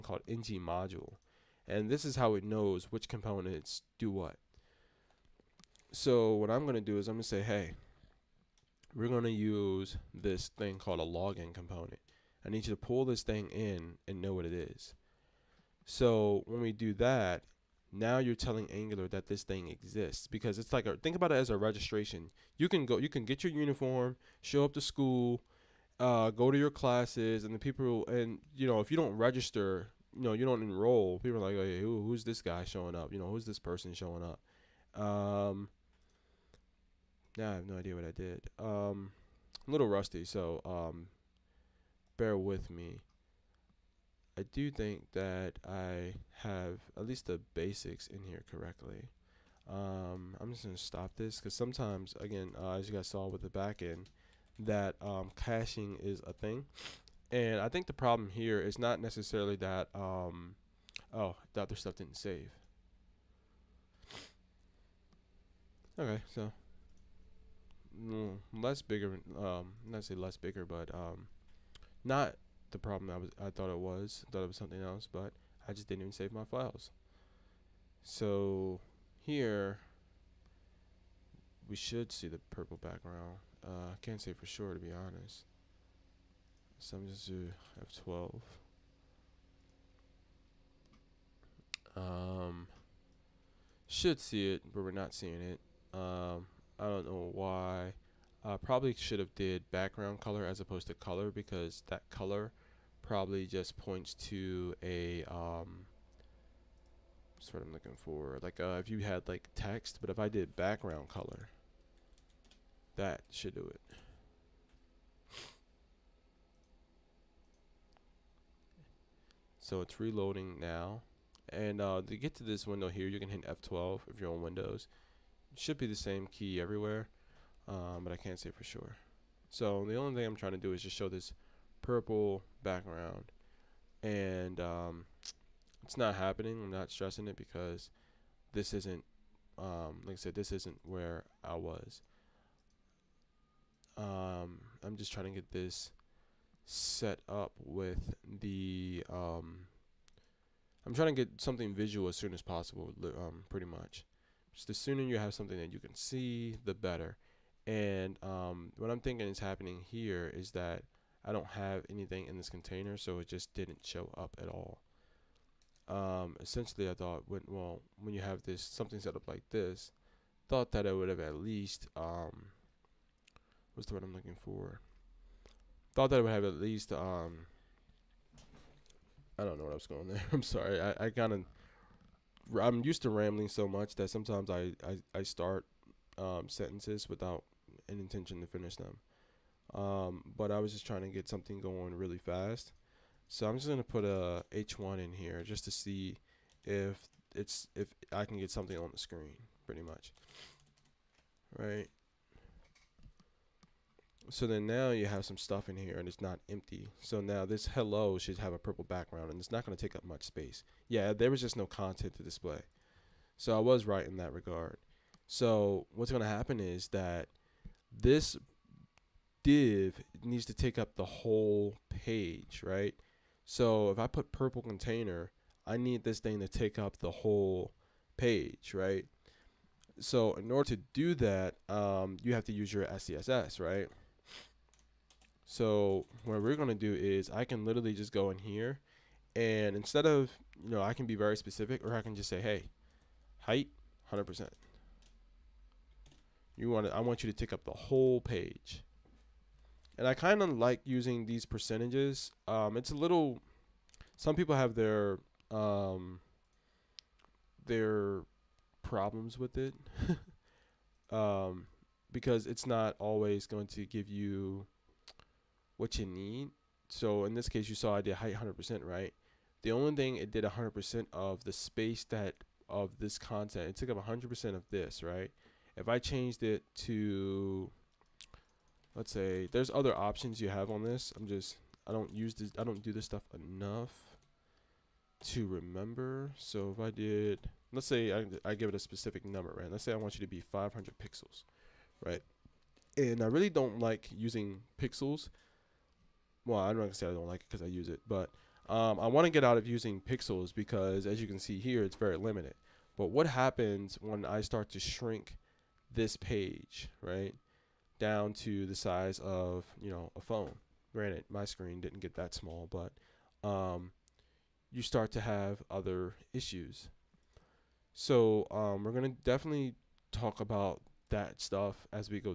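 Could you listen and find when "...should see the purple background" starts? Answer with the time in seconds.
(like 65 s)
81 s.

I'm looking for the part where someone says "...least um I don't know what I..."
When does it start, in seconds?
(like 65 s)
176 s.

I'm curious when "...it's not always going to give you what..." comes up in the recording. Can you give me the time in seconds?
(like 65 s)
262 s.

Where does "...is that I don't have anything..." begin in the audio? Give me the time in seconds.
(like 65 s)
160 s.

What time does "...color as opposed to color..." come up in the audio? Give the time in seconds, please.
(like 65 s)
100 s.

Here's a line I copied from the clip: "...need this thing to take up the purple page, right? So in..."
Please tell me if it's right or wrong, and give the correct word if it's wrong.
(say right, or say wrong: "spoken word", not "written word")
wrong: "whole", not "purple".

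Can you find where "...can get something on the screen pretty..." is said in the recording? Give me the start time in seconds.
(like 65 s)
198 s.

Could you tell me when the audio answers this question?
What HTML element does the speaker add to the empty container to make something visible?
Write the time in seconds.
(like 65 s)
194 s.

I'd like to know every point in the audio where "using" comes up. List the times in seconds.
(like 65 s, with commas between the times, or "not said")
250 s, 294 s, 299 s.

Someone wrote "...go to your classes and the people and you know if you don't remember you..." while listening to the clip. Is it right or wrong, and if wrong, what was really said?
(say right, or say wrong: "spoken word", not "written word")
wrong: "register", not "remember".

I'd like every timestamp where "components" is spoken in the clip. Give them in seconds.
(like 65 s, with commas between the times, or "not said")
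3 s, 11 s.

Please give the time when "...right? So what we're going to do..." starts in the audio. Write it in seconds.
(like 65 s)
233 s.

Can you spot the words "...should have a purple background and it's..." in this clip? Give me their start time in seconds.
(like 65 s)
208 s.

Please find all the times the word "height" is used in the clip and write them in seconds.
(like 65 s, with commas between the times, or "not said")
243 s, 268 s.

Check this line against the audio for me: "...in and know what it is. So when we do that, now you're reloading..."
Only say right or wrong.
wrong.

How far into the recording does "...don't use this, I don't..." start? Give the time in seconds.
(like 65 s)
281 s.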